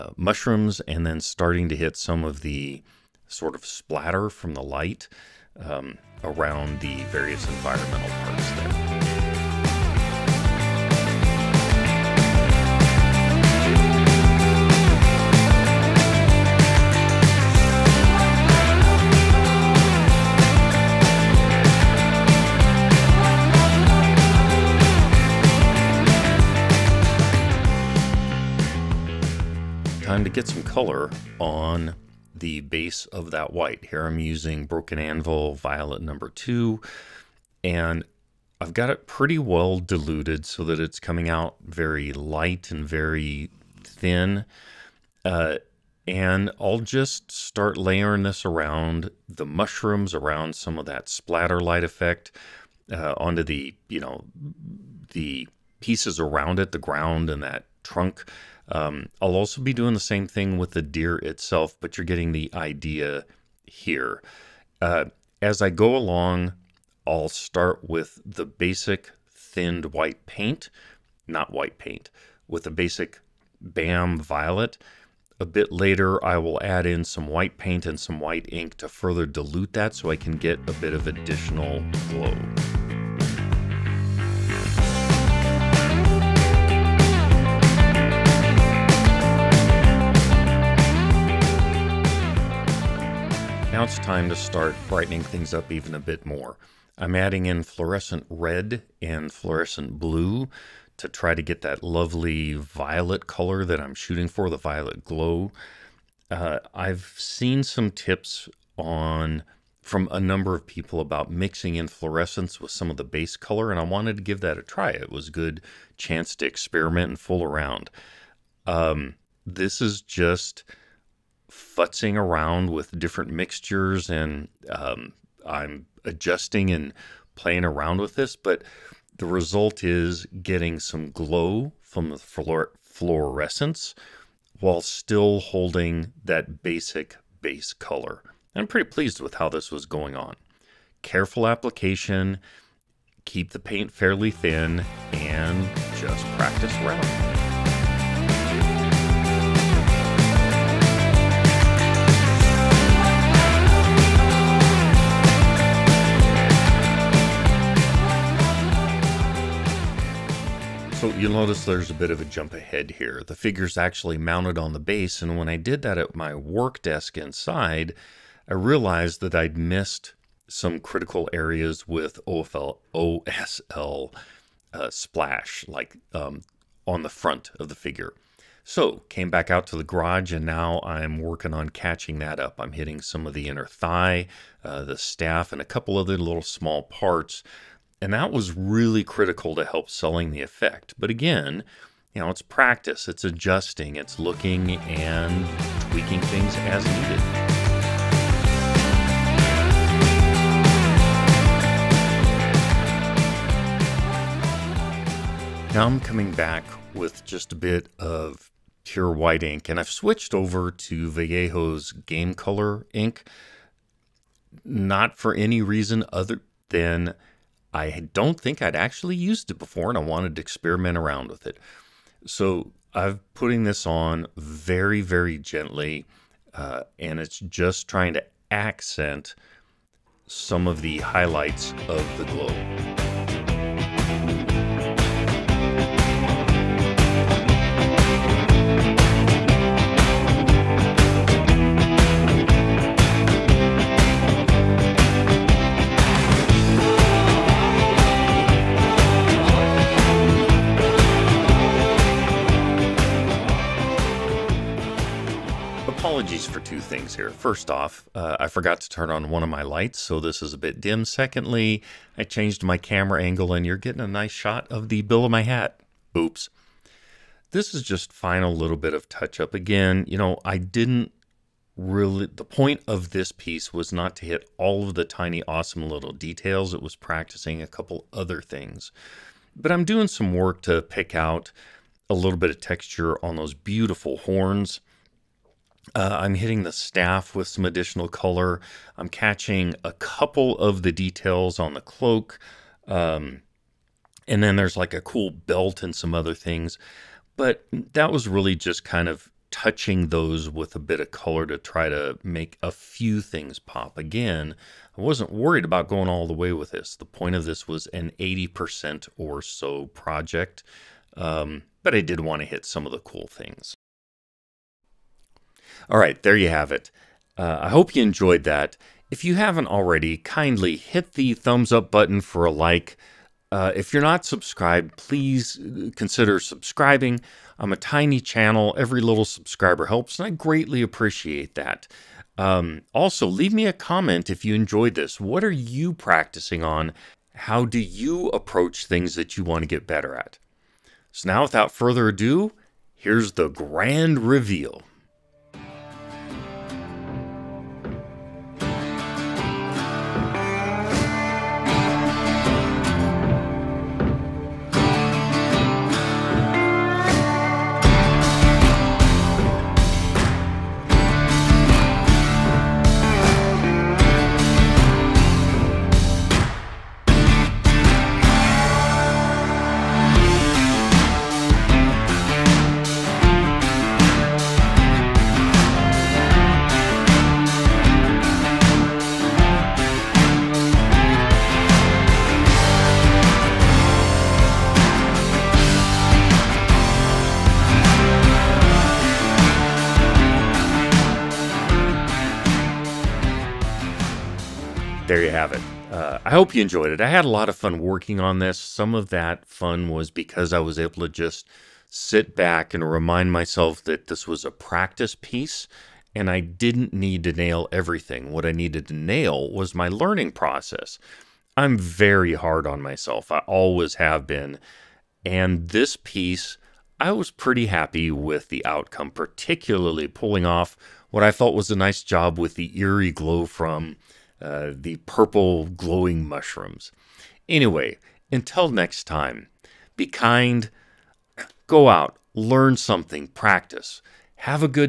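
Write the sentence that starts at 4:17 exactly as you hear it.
first off, uh, I forgot to turn on one of my lights, so this is a bit dim.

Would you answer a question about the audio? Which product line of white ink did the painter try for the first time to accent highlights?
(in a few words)
Vallejo Game Color.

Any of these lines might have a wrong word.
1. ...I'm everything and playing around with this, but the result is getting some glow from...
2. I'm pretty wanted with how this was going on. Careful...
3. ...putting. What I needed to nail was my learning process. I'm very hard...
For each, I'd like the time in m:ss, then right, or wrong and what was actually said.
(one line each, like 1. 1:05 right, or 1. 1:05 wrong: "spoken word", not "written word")
1. 2:05 wrong: "adjusting", not "everything"
2. 2:18 wrong: "pleased", not "wanted"
3. 6:47 wrong: "everything", not "putting".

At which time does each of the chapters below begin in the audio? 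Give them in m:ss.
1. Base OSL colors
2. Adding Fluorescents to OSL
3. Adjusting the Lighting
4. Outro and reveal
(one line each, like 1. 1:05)
1. 0:28
2. 1:32
3. 2:39
4. 5:14.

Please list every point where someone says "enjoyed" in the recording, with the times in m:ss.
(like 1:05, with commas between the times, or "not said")
5:18, 5:34, 6:36.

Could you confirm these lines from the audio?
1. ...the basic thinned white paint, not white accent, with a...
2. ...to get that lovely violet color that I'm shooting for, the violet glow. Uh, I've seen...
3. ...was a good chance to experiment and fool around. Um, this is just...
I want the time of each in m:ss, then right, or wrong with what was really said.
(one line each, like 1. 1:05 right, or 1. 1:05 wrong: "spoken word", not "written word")
1. 1:08 wrong: "paint", not "accent"
2. 1:41 right
3. 1:55 right.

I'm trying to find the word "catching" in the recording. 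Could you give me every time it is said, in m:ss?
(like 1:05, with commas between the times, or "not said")
3:01, 4:49.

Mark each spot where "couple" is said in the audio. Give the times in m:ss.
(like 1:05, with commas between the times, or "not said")
3:05, 4:37, 4:49.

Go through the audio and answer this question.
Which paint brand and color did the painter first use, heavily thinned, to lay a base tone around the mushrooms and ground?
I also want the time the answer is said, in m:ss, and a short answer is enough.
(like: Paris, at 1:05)
Broken Anvil Violet, at 0:34.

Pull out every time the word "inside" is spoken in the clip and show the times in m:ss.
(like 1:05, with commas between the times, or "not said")
2:47.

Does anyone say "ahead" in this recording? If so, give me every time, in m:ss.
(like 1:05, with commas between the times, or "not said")
2:42.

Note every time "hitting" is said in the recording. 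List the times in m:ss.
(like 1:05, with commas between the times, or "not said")
3:02, 4:46.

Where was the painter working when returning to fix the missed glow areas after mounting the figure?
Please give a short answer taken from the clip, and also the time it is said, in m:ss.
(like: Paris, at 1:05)
The garage, at 2:59.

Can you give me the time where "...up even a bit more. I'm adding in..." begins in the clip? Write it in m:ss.
1:35.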